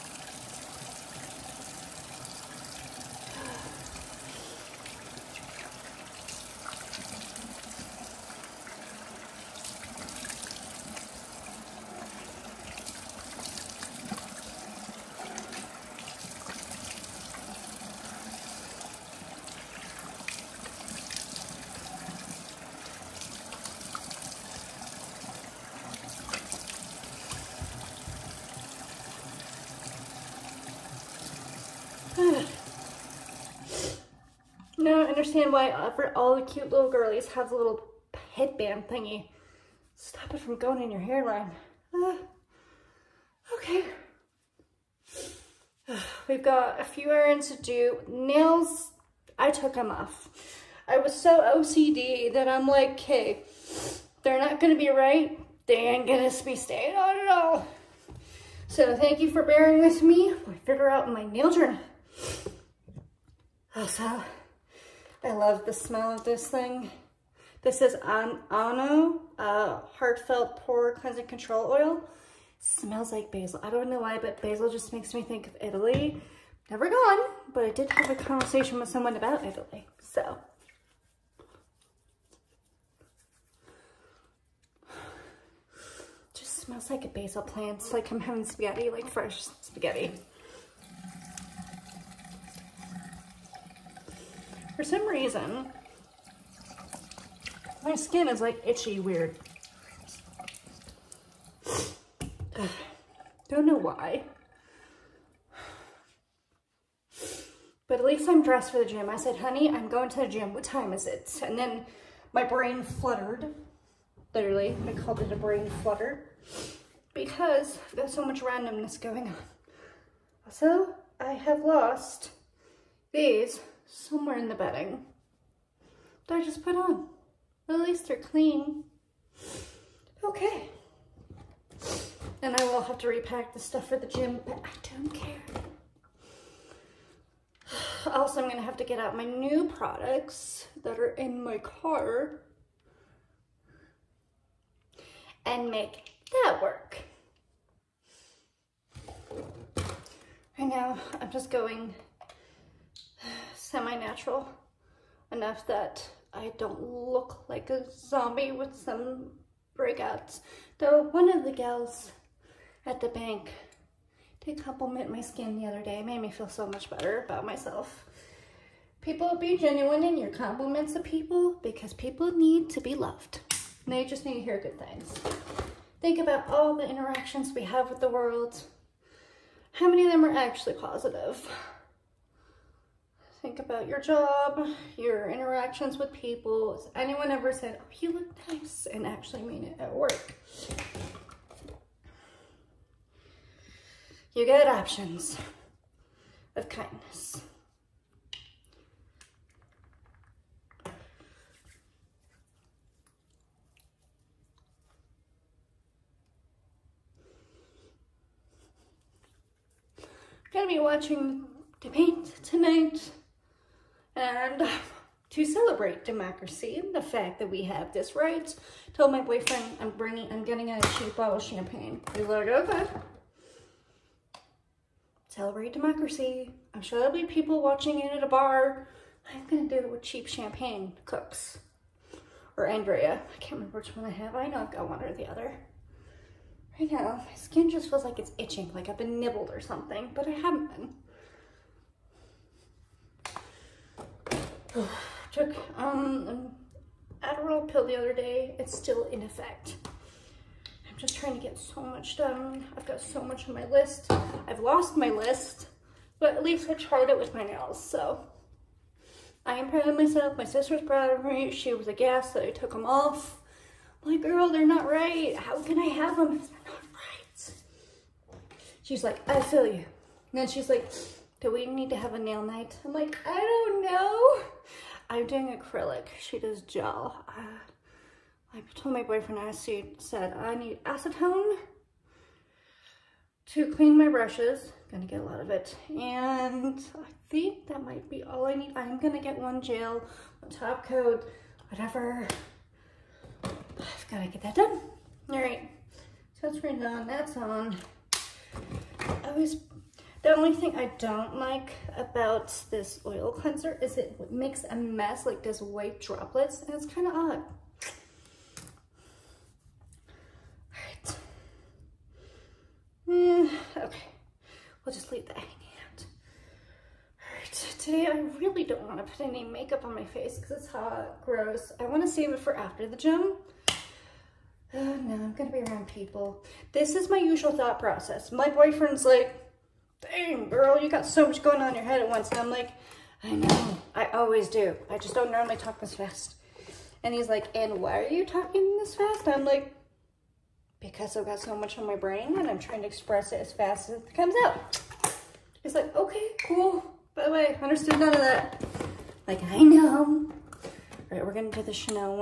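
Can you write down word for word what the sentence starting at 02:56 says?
Think about all the interactions we have with the world.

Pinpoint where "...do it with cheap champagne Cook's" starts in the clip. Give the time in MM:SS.
03:49.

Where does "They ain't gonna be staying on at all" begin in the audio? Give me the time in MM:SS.
00:55.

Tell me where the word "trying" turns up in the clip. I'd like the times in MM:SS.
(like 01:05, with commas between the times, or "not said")
04:11, 05:42.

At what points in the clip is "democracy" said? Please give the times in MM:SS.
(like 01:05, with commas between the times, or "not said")
03:36, 03:45.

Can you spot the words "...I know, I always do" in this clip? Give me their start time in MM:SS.
05:33.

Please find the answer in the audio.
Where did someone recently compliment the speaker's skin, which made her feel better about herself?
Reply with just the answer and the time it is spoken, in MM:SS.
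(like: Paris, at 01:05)
the bank, at 02:41.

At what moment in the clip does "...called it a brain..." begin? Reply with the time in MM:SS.
01:54.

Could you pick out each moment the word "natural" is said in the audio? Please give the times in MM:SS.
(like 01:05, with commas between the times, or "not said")
02:33.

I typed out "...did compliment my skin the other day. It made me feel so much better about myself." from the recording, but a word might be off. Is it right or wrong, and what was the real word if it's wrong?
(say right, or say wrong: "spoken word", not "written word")
right.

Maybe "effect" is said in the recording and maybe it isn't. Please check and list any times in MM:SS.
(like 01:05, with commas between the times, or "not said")
04:09.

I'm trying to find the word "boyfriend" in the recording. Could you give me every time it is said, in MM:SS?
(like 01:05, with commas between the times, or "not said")
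03:39, 04:39, 05:28.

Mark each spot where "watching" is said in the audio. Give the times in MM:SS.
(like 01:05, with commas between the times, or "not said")
03:30, 03:47.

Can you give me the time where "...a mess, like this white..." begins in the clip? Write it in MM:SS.
05:04.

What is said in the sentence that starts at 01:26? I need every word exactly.
Just smells like a basil plant.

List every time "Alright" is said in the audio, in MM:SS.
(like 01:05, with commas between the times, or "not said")
05:10, 05:17.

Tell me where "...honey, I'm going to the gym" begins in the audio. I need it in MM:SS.
01:49.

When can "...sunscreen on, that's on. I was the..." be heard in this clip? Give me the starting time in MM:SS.
04:56.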